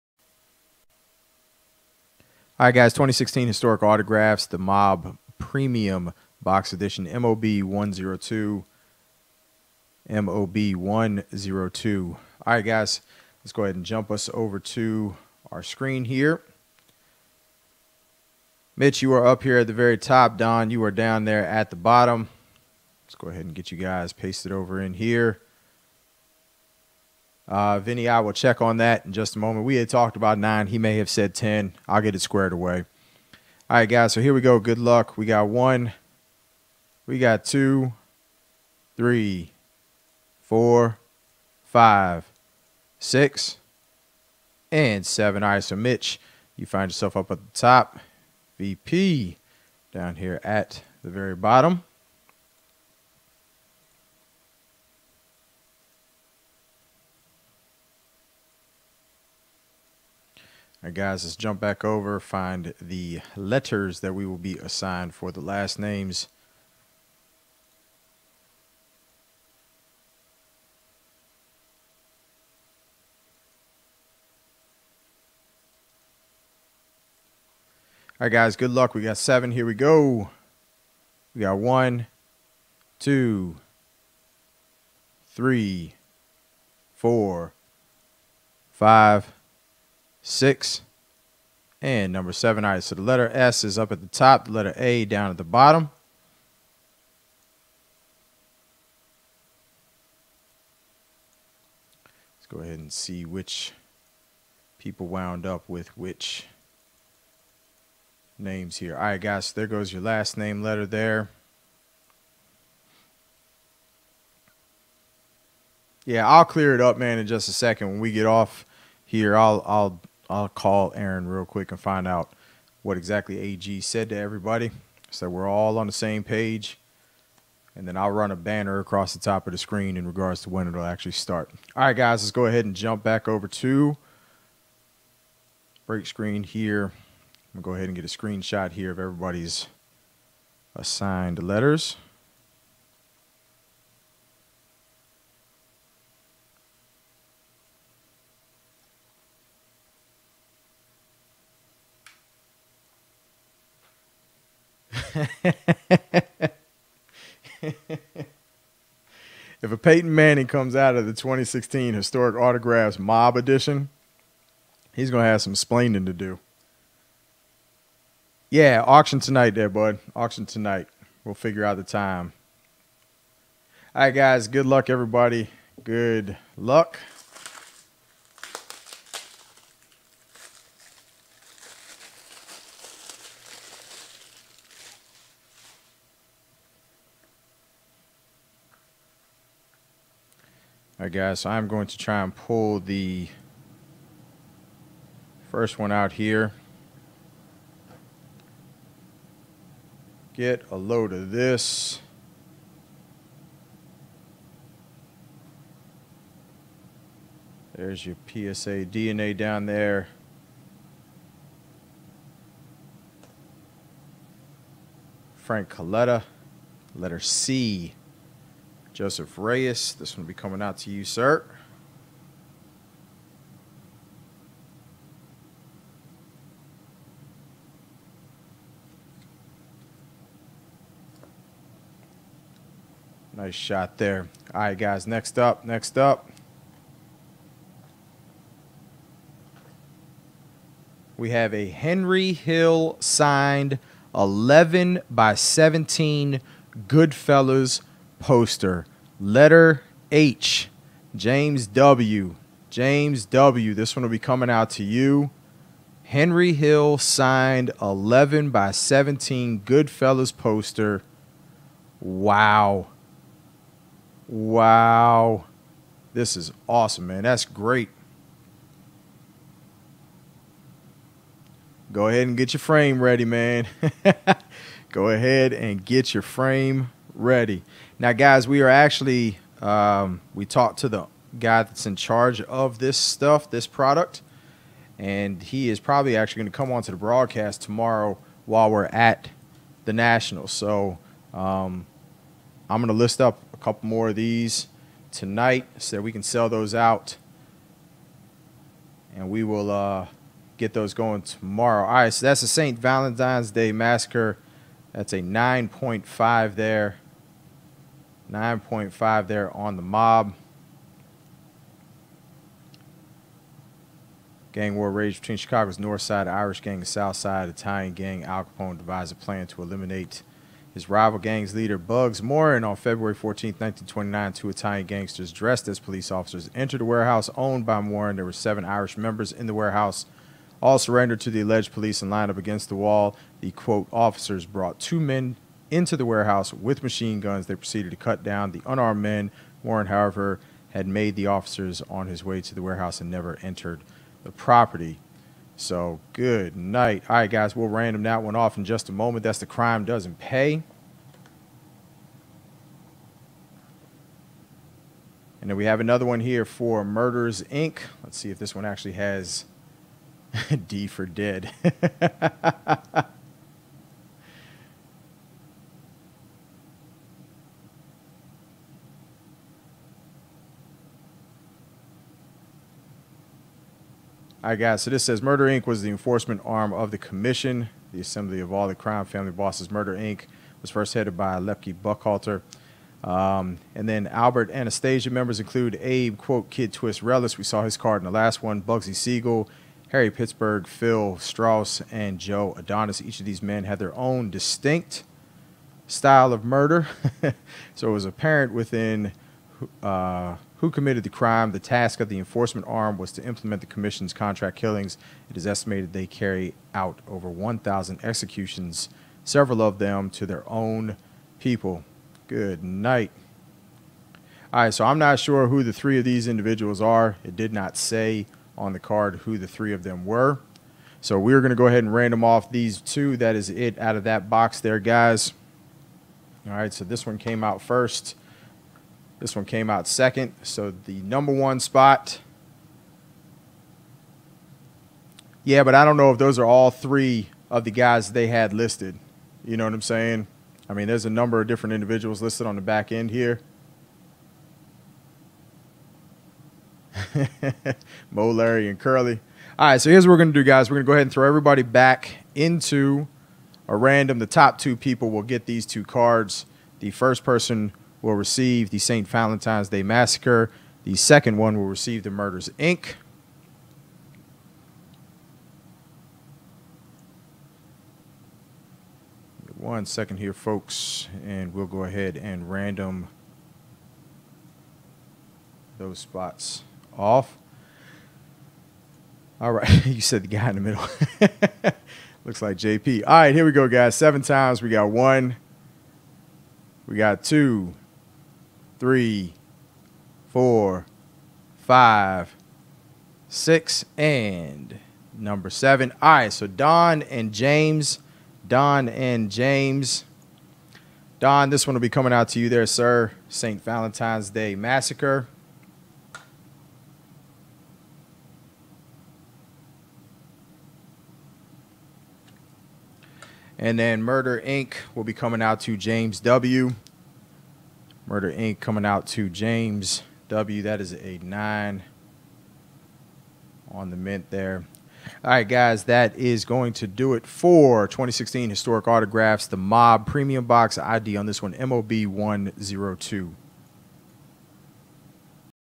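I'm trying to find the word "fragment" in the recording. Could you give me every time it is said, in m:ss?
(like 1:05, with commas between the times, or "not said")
not said.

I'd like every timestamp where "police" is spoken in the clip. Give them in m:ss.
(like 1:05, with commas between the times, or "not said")
5:25, 5:31.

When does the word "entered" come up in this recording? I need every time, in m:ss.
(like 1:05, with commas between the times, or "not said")
5:26, 5:43.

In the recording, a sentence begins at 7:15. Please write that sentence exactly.
Yeah, but I don't know if those are all three of the guys they had listed.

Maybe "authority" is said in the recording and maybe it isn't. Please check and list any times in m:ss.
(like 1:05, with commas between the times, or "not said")
not said.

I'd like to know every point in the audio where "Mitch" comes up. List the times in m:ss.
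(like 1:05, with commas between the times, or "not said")
0:18, 0:45.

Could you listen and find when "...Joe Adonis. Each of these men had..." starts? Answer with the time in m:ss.
6:32.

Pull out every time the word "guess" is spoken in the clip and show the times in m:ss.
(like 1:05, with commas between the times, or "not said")
3:11.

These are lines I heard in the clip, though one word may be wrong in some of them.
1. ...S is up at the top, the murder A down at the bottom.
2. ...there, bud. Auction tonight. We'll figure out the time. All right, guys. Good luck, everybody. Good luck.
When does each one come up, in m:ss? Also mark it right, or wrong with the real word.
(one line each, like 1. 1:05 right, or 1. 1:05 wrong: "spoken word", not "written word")
1. 1:33 wrong: "letter", not "murder"
2. 2:49 right.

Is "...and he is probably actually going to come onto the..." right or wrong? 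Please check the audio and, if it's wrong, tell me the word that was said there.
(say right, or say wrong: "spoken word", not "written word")
right.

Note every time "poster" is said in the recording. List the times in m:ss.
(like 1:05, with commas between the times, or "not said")
4:08, 4:20.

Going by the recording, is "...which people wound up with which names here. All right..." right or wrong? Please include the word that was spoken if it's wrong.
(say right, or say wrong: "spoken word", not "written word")
right.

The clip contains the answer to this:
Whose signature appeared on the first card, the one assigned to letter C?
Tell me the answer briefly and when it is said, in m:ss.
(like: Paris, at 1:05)
Frank Coletta, at 3:35.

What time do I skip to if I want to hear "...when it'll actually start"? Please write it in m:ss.
2:10.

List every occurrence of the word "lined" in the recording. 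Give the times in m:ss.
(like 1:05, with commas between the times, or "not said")
5:32.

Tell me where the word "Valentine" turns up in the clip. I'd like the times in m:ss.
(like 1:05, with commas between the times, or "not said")
5:02, 7:39, 8:23.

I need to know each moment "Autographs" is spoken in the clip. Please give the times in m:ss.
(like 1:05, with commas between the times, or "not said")
0:03, 2:42, 8:48.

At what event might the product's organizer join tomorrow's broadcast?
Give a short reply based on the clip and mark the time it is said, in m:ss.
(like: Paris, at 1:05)
the Nationals, at 4:49.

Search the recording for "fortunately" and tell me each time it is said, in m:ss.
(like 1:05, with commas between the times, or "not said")
not said.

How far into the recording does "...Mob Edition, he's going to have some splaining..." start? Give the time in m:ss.
2:42.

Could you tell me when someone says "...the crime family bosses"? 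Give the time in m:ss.
6:18.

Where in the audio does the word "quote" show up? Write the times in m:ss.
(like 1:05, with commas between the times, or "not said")
5:33, 6:26.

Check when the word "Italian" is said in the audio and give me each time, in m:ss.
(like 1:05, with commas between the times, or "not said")
5:17, 5:24.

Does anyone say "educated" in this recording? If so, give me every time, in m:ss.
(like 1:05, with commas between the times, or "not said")
not said.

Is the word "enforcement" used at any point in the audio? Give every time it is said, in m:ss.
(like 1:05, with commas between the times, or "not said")
6:15, 6:42.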